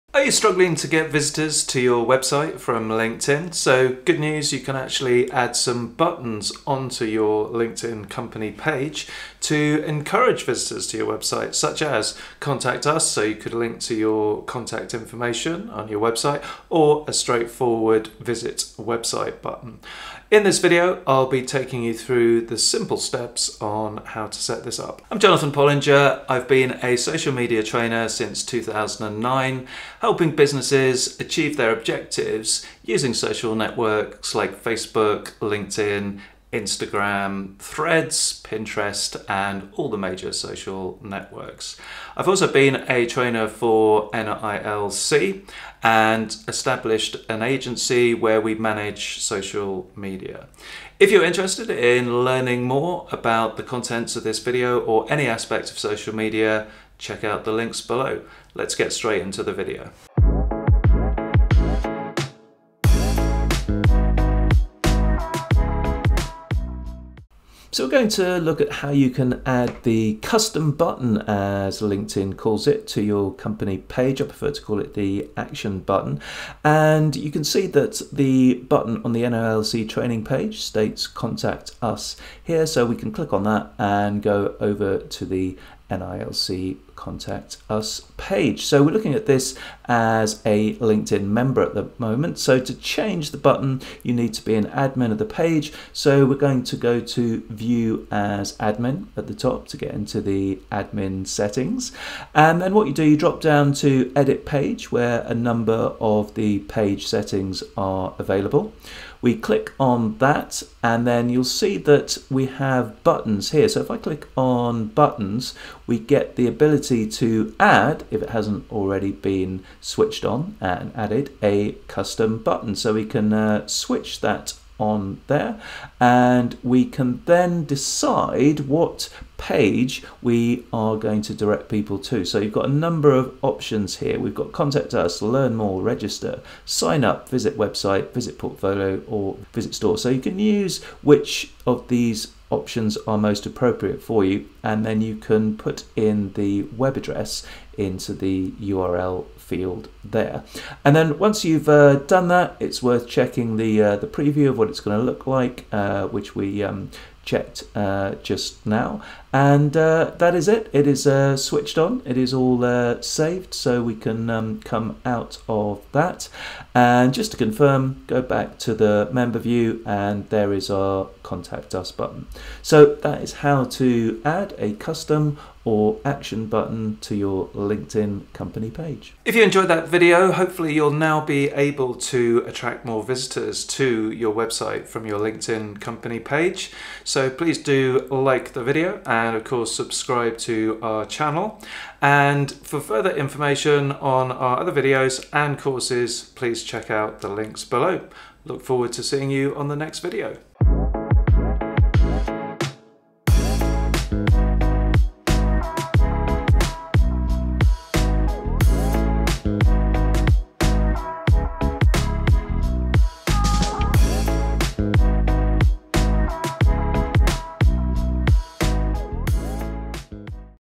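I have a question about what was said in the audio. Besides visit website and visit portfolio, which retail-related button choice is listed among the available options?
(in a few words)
visit store.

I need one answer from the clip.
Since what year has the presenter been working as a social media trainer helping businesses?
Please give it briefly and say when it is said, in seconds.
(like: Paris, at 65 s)
2009, at 28 s.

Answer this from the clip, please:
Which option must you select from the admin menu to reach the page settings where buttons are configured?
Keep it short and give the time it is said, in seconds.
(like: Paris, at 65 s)
edit page, at 104 s.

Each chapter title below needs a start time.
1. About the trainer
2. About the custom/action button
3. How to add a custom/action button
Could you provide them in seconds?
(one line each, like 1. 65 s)
1. 24 s
2. 67 s
3. 92 s.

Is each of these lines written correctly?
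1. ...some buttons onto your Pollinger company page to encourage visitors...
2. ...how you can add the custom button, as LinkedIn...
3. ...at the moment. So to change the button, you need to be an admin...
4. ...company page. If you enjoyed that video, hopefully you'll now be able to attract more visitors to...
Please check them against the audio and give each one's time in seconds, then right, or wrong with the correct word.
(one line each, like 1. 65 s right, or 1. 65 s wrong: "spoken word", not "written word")
1. 5 s wrong: "LinkedIn", not "Pollinger"
2. 68 s right
3. 91 s right
4. 178 s right.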